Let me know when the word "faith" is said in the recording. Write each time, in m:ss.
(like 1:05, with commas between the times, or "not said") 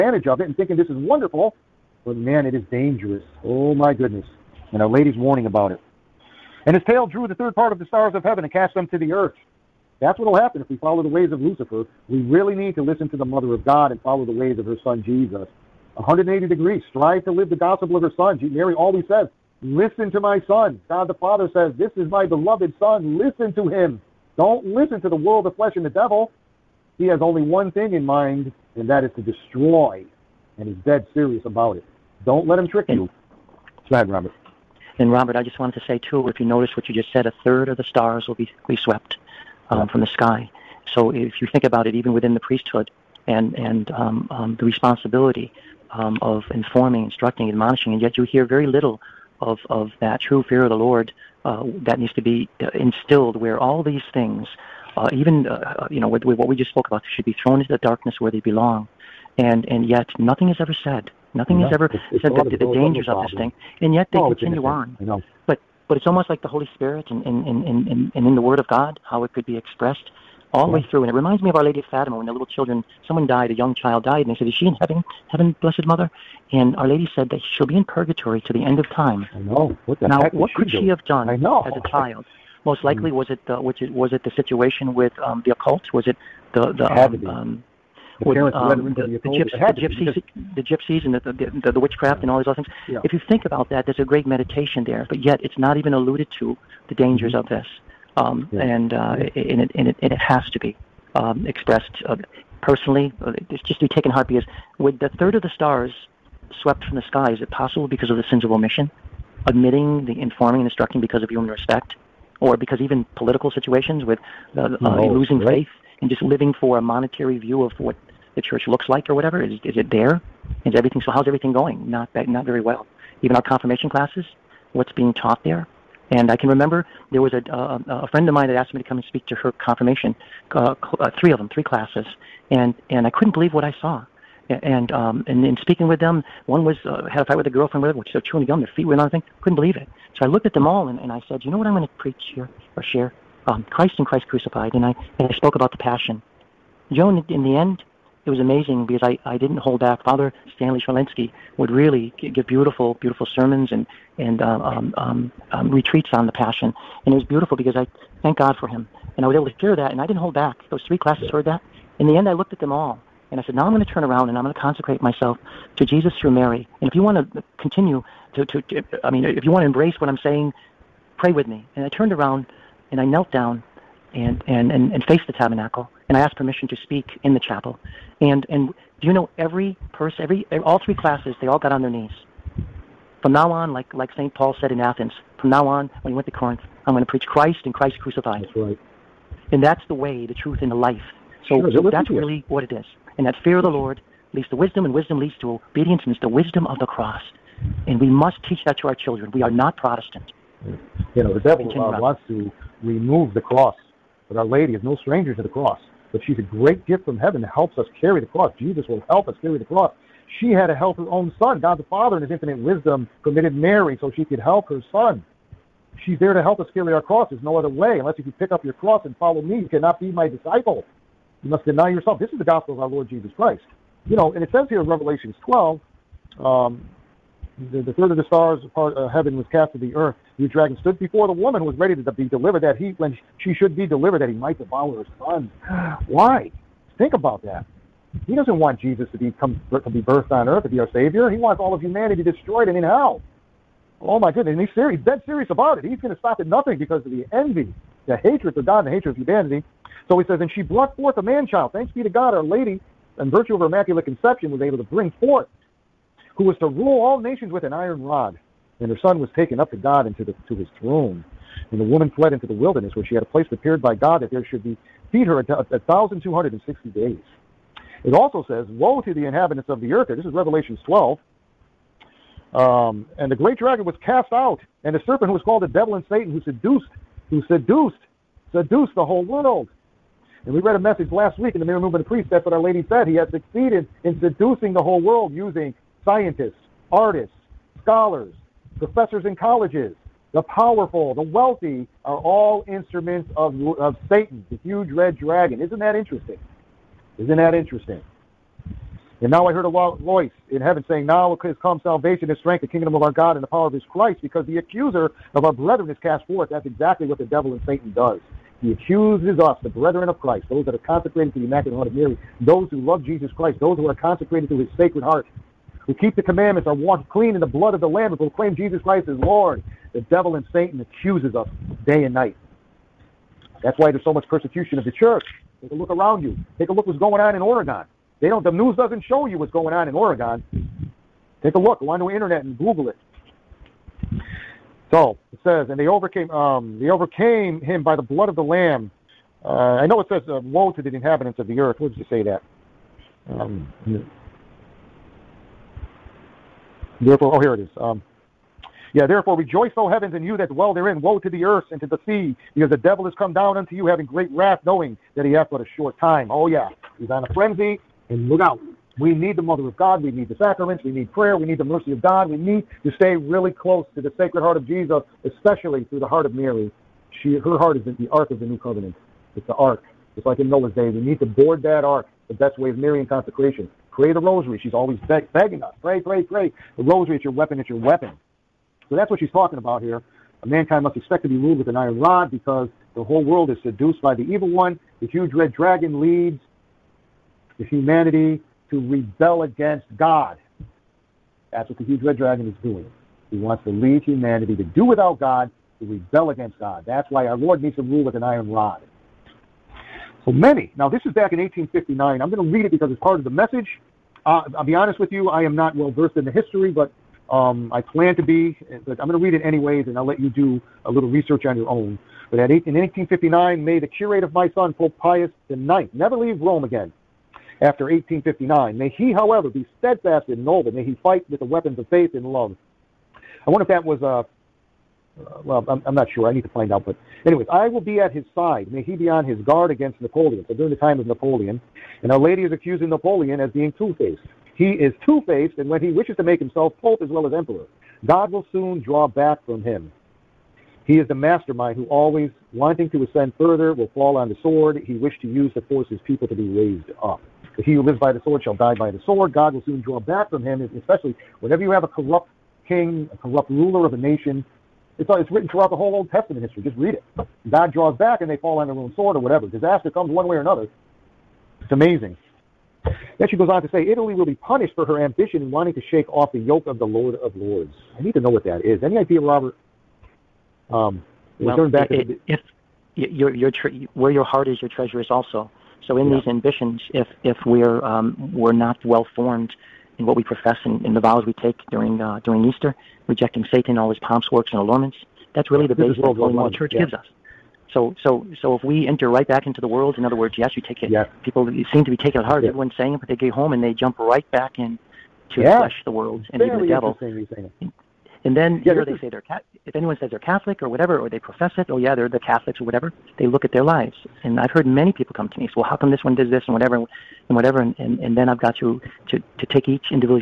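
1:55, 7:01.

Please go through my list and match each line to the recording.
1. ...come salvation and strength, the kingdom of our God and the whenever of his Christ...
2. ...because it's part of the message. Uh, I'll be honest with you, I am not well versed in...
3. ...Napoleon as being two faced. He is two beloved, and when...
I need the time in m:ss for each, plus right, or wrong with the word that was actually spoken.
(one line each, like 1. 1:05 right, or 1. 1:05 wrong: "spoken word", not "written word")
1. 5:01 wrong: "power", not "whenever"
2. 6:42 right
3. 7:12 wrong: "faced", not "beloved".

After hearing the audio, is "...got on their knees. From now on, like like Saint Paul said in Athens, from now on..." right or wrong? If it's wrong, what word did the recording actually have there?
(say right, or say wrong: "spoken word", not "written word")
right.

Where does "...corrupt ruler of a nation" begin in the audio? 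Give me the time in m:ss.
7:33.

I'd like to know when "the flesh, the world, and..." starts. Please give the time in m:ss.
8:15.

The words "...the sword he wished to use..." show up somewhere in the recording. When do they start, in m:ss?
7:24.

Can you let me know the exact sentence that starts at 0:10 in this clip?
That's what will happen if we follow the ways of Lucifer.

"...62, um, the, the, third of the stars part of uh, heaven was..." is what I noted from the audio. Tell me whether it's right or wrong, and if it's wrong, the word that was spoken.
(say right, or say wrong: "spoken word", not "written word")
wrong: "12", not "62".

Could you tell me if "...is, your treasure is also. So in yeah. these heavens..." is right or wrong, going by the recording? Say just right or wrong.
wrong.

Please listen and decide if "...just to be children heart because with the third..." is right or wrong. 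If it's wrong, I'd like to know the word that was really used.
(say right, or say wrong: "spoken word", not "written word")
wrong: "taken", not "children".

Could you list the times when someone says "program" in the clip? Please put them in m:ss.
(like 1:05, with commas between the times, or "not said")
not said.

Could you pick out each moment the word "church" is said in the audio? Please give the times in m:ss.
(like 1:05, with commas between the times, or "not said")
1:58, 5:24, 8:06.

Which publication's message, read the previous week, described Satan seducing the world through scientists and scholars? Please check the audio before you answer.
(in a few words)
Marian Movement of Priests.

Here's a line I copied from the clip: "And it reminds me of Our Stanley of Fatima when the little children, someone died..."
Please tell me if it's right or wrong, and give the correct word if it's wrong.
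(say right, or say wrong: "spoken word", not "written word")
wrong: "Lady", not "Stanley".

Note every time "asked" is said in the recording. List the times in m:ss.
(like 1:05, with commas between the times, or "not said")
2:08, 2:56.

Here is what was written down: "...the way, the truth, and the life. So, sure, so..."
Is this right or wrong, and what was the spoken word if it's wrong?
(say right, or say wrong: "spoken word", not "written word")
right.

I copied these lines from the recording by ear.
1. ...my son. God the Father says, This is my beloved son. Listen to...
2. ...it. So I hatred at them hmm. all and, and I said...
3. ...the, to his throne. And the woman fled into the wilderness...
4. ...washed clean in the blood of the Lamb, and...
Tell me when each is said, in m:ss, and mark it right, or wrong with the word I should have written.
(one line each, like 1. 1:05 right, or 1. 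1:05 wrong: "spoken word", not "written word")
1. 0:20 right
2. 2:19 wrong: "looked", not "hatred"
3. 4:20 right
4. 5:16 right.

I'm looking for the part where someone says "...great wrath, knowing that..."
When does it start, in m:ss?
5:54.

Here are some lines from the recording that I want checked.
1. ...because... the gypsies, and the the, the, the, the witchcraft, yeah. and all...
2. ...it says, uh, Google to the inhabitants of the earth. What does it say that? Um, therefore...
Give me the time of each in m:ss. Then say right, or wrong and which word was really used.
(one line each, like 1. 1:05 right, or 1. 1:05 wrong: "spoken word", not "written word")
1. 1:30 right
2. 5:39 wrong: "Woe", not "Google".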